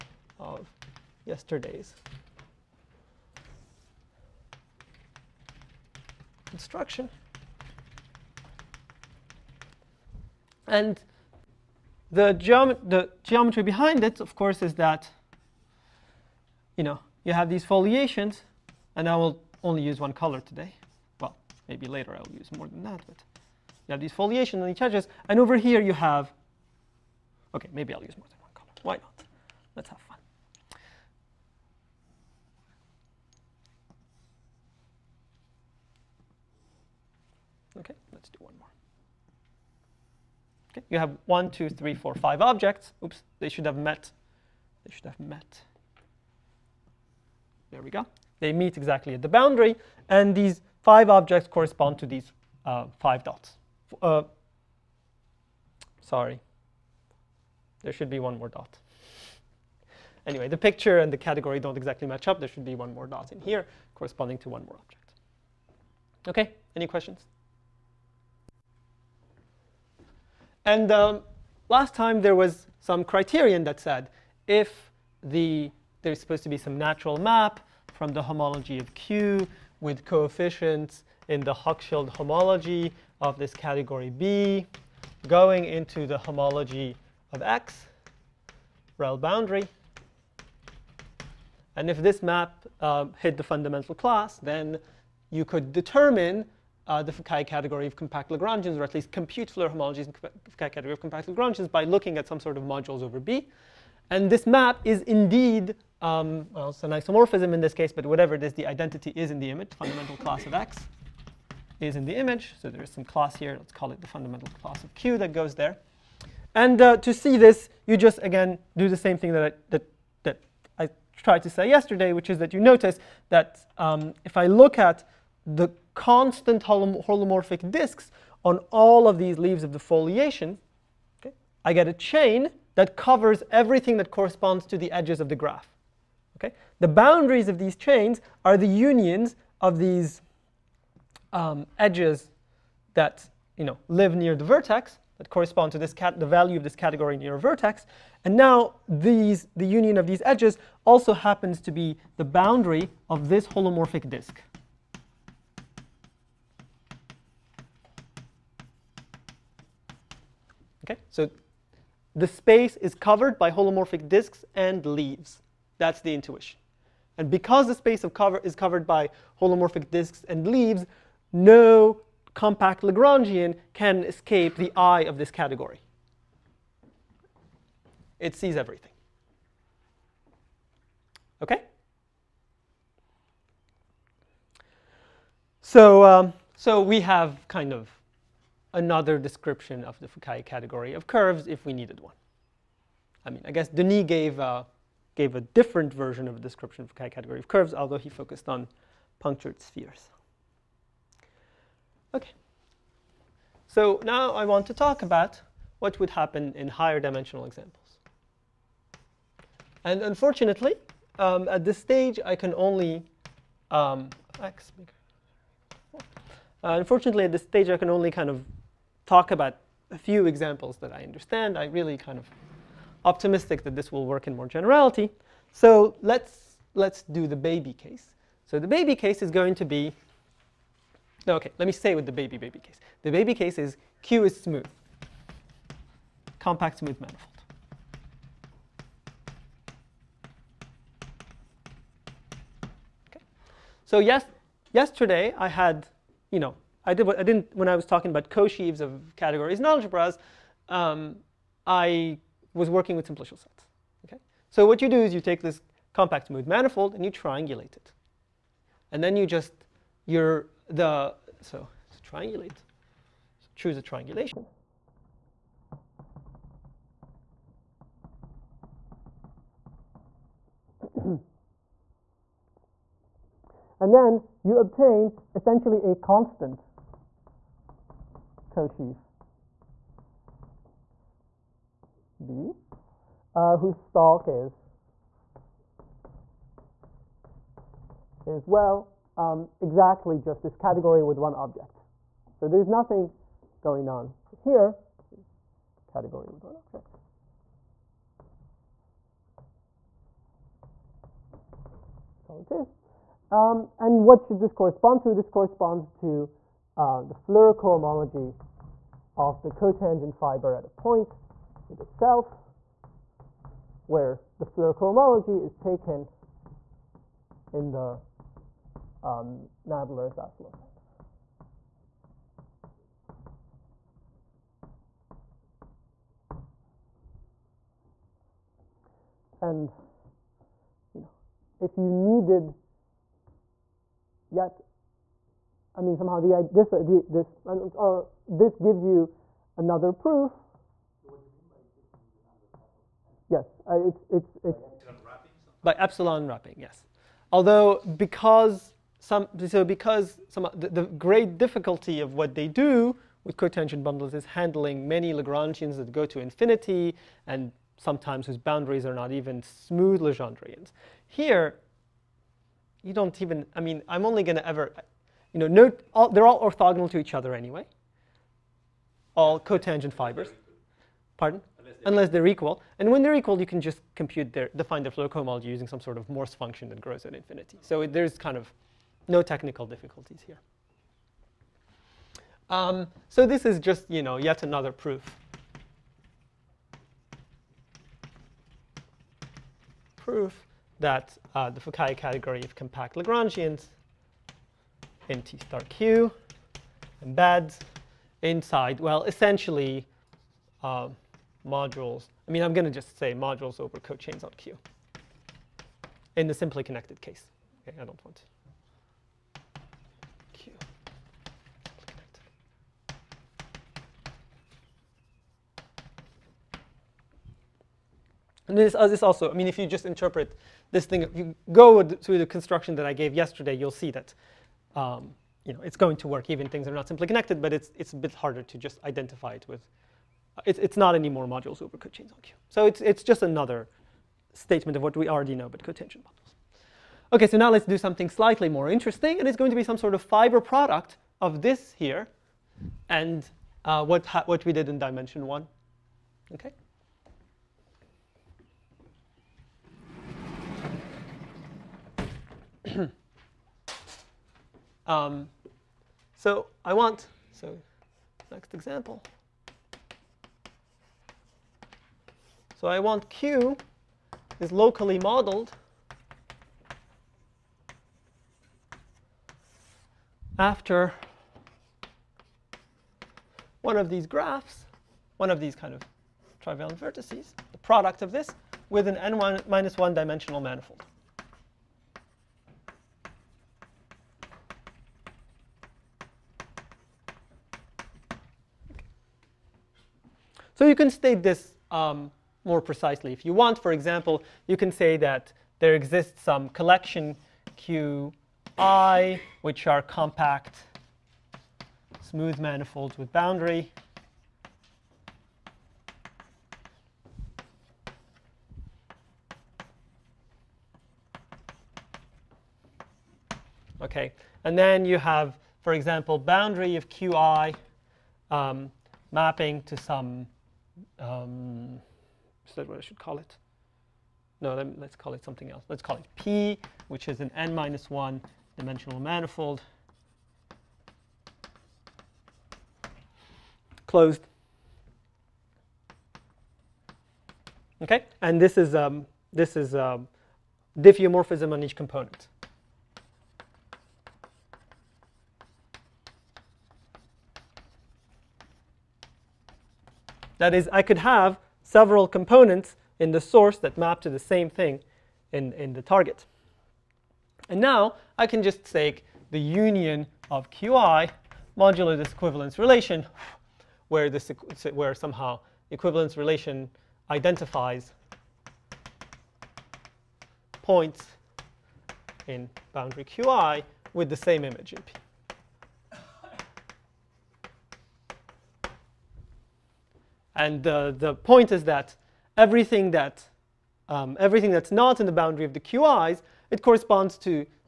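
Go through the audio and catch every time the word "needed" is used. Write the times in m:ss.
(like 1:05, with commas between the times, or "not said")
3:11, 5:31.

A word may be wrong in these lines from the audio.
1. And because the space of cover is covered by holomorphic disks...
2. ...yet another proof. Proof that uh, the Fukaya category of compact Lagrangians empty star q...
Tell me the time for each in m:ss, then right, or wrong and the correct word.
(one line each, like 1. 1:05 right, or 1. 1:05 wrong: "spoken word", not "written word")
1. 2:47 right
2. 6:24 right.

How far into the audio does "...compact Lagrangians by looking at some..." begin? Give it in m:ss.
1:40.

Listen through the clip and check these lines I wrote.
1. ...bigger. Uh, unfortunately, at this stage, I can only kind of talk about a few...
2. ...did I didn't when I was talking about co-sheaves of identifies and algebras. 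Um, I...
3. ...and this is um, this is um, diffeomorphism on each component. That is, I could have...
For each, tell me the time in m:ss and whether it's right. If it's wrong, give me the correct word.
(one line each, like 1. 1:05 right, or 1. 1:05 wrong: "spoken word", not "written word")
1. 3:34 right
2. 4:06 wrong: "categories", not "identifies"
3. 8:58 right.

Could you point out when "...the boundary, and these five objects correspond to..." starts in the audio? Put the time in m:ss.
0:49.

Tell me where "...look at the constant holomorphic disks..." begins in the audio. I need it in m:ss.
2:04.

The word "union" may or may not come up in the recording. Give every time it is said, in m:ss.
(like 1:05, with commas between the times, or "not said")
2:18, 2:29, 9:19.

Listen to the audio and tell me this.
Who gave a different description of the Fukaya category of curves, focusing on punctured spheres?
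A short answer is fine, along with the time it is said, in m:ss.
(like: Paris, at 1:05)
Denis, at 3:13.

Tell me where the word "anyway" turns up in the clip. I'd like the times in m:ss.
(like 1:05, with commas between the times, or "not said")
1:00, 6:07.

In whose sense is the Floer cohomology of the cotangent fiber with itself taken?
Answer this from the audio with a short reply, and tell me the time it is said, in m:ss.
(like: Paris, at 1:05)
Nadler-Zaslow, at 5:19.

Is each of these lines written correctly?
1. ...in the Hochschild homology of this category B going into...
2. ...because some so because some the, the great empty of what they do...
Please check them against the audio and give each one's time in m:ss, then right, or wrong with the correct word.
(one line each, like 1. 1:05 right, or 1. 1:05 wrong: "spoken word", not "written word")
1. 1:21 right
2. 5:47 wrong: "difficulty", not "empty".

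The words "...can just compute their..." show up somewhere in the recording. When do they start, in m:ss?
6:13.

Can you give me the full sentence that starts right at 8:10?
you can state this um, more precisely if you want.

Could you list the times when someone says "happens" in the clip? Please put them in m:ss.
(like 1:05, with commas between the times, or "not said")
2:31, 3:26.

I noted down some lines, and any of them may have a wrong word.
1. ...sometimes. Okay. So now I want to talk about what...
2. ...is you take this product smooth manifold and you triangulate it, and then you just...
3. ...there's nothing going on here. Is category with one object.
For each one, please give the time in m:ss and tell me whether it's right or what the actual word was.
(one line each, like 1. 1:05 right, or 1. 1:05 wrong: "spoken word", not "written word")
1. 3:19 wrong: "spheres", not "sometimes"
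2. 4:15 wrong: "compact", not "product"
3. 4:52 right.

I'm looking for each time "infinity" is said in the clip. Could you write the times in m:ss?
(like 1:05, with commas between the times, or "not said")
5:56, 6:17.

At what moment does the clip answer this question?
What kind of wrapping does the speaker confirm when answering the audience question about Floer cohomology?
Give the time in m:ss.
5:44.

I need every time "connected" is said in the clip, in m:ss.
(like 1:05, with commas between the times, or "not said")
6:46, 7:07.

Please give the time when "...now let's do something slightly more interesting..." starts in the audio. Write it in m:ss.
7:17.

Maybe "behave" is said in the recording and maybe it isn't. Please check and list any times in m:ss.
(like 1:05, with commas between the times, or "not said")
not said.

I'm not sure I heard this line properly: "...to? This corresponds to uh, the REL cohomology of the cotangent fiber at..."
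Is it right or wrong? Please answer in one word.
wrong.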